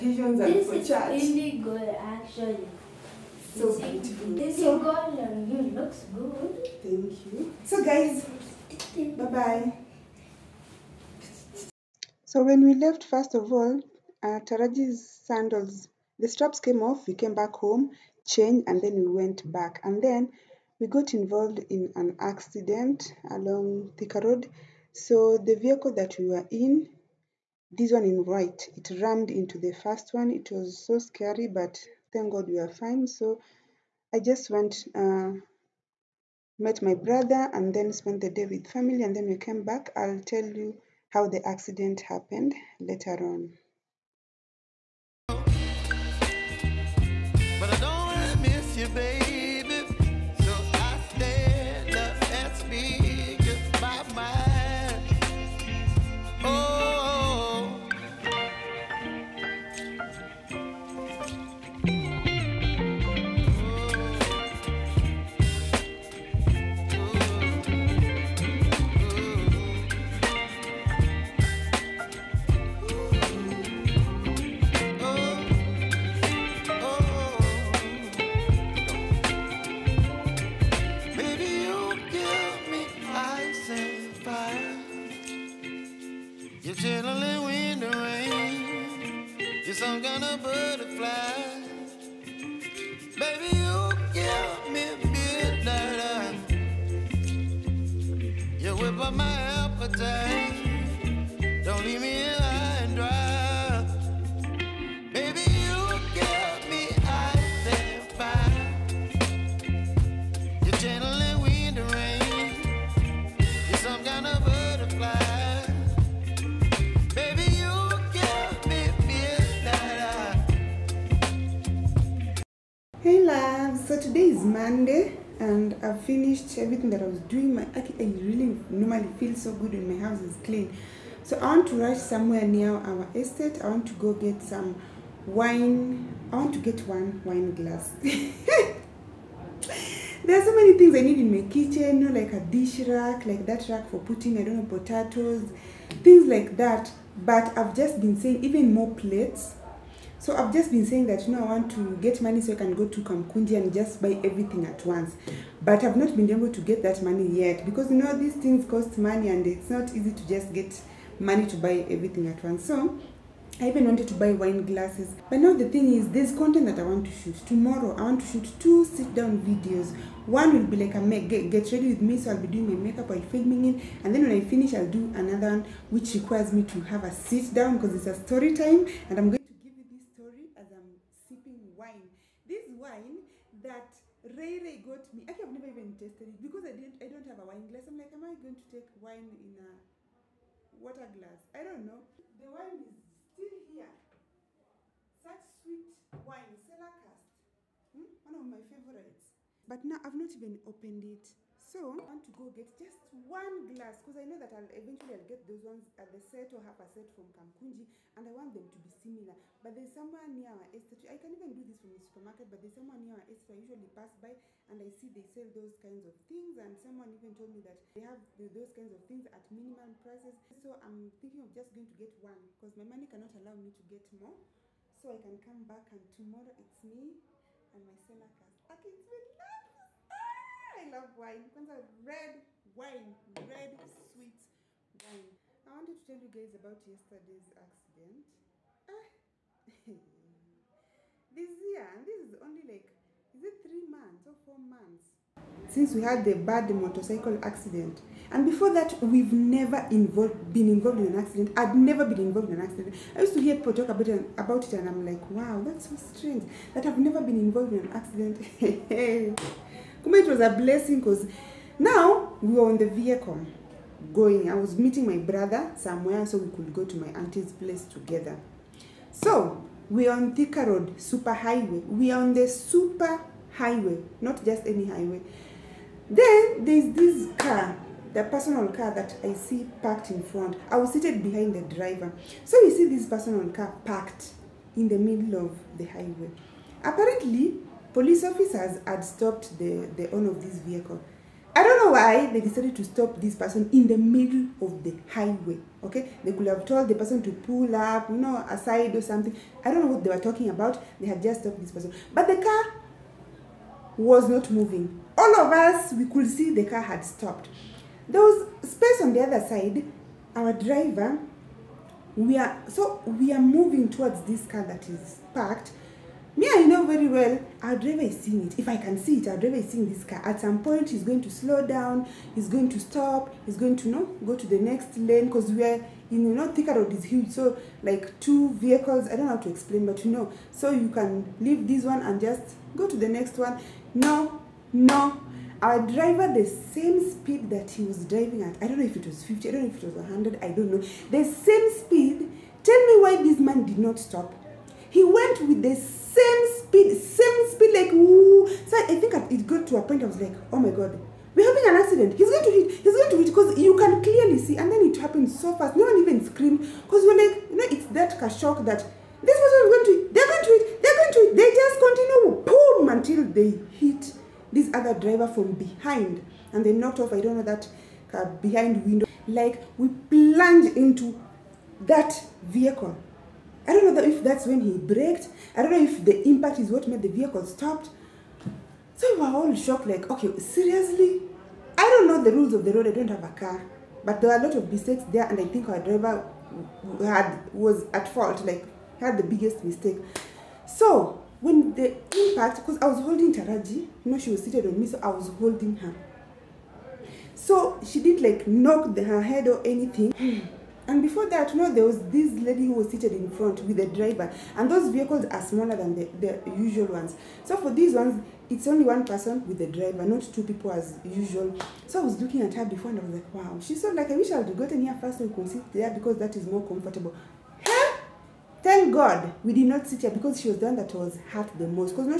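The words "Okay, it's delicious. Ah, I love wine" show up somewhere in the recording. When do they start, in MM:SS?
03:48.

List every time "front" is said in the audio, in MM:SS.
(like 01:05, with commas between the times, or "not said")
04:40, 06:43.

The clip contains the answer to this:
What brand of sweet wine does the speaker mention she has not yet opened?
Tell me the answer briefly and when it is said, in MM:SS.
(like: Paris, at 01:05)
Cellar Cask, at 03:16.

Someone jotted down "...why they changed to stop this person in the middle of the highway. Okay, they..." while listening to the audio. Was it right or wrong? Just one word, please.
wrong.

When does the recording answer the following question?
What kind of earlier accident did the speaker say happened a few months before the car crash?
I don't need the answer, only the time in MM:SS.
04:06.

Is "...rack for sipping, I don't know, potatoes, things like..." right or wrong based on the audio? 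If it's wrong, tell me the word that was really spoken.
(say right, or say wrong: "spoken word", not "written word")
wrong: "putting", not "sipping".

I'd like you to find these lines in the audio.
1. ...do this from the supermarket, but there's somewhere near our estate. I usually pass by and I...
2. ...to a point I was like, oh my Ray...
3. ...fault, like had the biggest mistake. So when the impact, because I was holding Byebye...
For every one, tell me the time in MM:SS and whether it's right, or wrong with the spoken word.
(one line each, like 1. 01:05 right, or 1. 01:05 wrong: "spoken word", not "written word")
1. 03:31 right
2. 05:49 wrong: "God", not "Ray"
3. 06:28 wrong: "Taraji", not "Byebye".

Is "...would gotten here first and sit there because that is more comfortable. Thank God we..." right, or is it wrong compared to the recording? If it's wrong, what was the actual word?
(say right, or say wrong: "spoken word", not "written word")
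right.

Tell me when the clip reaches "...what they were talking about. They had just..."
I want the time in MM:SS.
04:59.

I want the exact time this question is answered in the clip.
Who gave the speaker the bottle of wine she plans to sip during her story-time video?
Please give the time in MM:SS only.
03:04.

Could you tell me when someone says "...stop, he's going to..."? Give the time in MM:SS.
05:22.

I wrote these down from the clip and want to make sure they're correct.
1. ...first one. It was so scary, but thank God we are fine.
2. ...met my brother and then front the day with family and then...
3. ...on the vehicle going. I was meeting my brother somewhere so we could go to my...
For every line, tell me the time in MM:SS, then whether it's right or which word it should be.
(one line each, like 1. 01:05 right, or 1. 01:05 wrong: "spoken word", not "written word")
1. 00:29 right
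2. 00:36 wrong: "spent", not "front"
3. 04:22 right.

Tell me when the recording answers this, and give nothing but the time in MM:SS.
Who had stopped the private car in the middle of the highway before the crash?
04:47.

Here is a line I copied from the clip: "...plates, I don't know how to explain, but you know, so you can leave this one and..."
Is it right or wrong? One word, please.
wrong.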